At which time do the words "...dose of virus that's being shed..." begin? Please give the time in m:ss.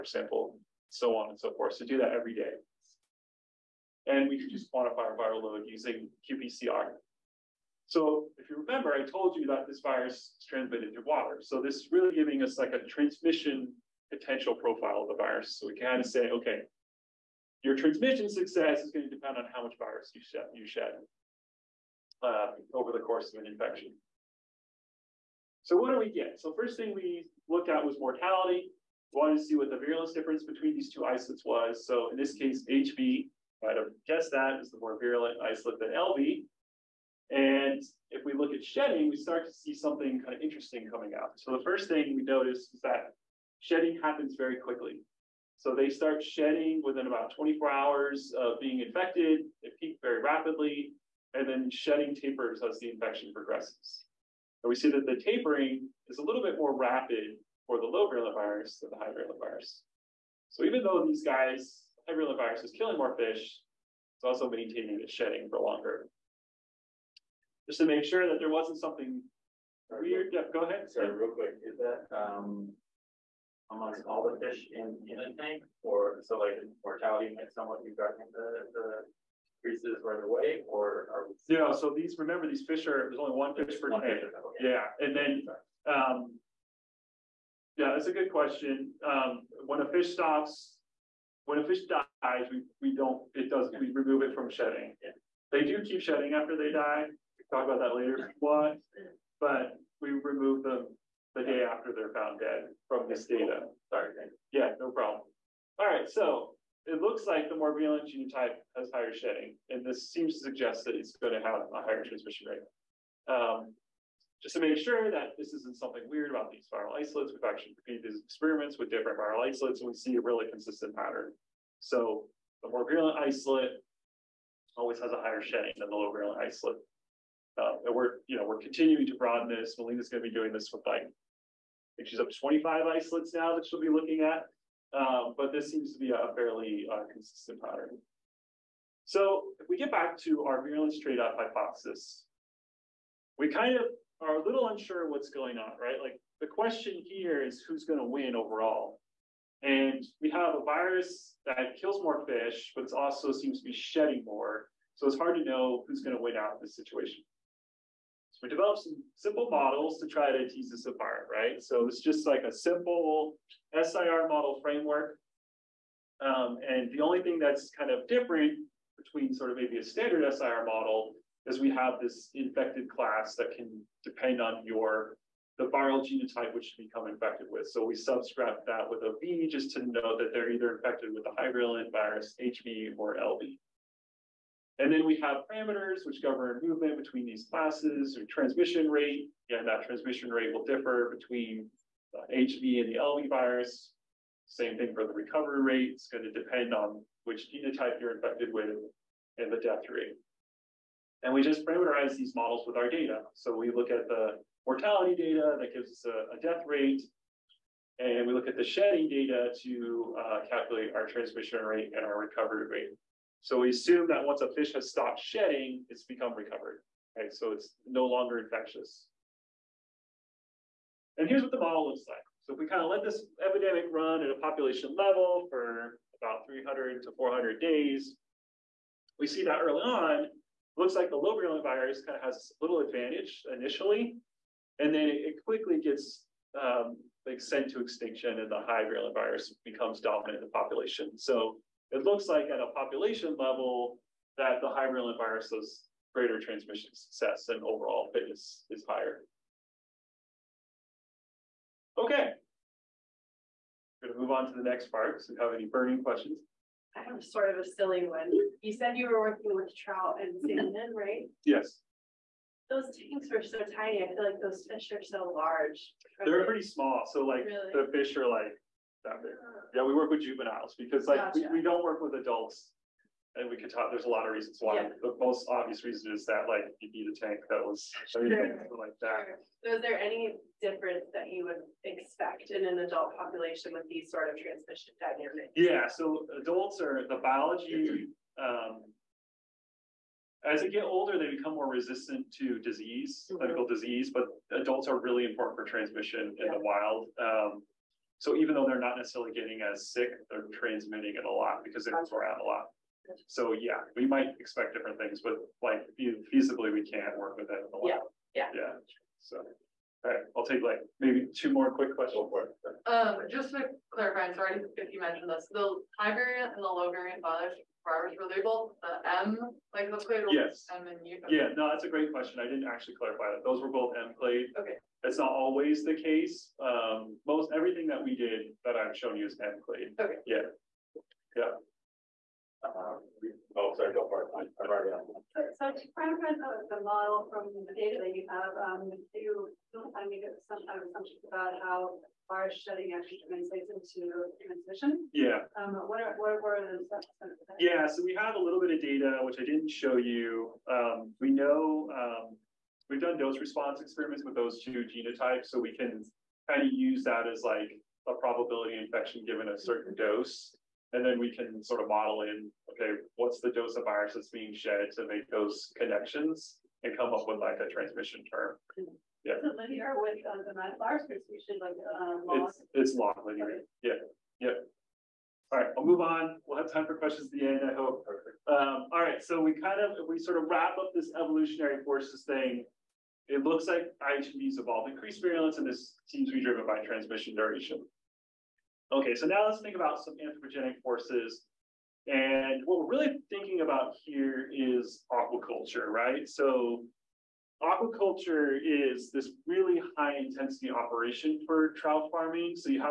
6:03.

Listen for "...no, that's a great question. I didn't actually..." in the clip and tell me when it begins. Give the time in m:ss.
5:21.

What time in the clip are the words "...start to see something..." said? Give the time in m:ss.
0:39.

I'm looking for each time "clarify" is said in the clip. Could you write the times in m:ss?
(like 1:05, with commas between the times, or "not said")
5:13, 5:22.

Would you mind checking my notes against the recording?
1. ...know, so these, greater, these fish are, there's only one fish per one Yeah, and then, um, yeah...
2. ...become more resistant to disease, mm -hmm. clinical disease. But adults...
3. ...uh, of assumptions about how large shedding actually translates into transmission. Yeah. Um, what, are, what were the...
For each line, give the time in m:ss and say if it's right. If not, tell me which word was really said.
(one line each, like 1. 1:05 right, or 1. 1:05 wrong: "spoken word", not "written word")
1. 1:21 wrong: "remember", not "greater"
2. 4:51 right
3. 5:40 right.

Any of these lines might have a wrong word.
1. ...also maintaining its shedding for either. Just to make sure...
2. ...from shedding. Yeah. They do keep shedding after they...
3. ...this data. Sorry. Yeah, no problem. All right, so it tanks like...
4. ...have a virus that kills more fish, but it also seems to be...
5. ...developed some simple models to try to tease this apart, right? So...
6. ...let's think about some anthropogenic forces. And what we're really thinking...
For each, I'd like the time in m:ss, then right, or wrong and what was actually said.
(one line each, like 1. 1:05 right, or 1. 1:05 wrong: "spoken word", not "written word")
1. 1:04 wrong: "longer", not "either"
2. 1:34 right
3. 1:43 wrong: "looks", not "tanks"
4. 2:30 right
5. 2:38 right
6. 6:29 right.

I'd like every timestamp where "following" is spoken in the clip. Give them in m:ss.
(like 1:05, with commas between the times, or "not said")
not said.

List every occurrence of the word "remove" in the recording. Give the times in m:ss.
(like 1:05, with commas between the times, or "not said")
1:33, 1:40.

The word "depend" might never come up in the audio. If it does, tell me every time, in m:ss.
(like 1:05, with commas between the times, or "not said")
0:19, 2:54, 3:16.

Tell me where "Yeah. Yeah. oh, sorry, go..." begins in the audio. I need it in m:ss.
5:30.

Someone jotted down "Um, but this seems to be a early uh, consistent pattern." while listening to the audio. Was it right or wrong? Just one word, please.
wrong.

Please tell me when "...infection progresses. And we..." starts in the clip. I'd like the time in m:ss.
0:52.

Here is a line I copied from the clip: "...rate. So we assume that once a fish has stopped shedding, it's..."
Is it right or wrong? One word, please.
right.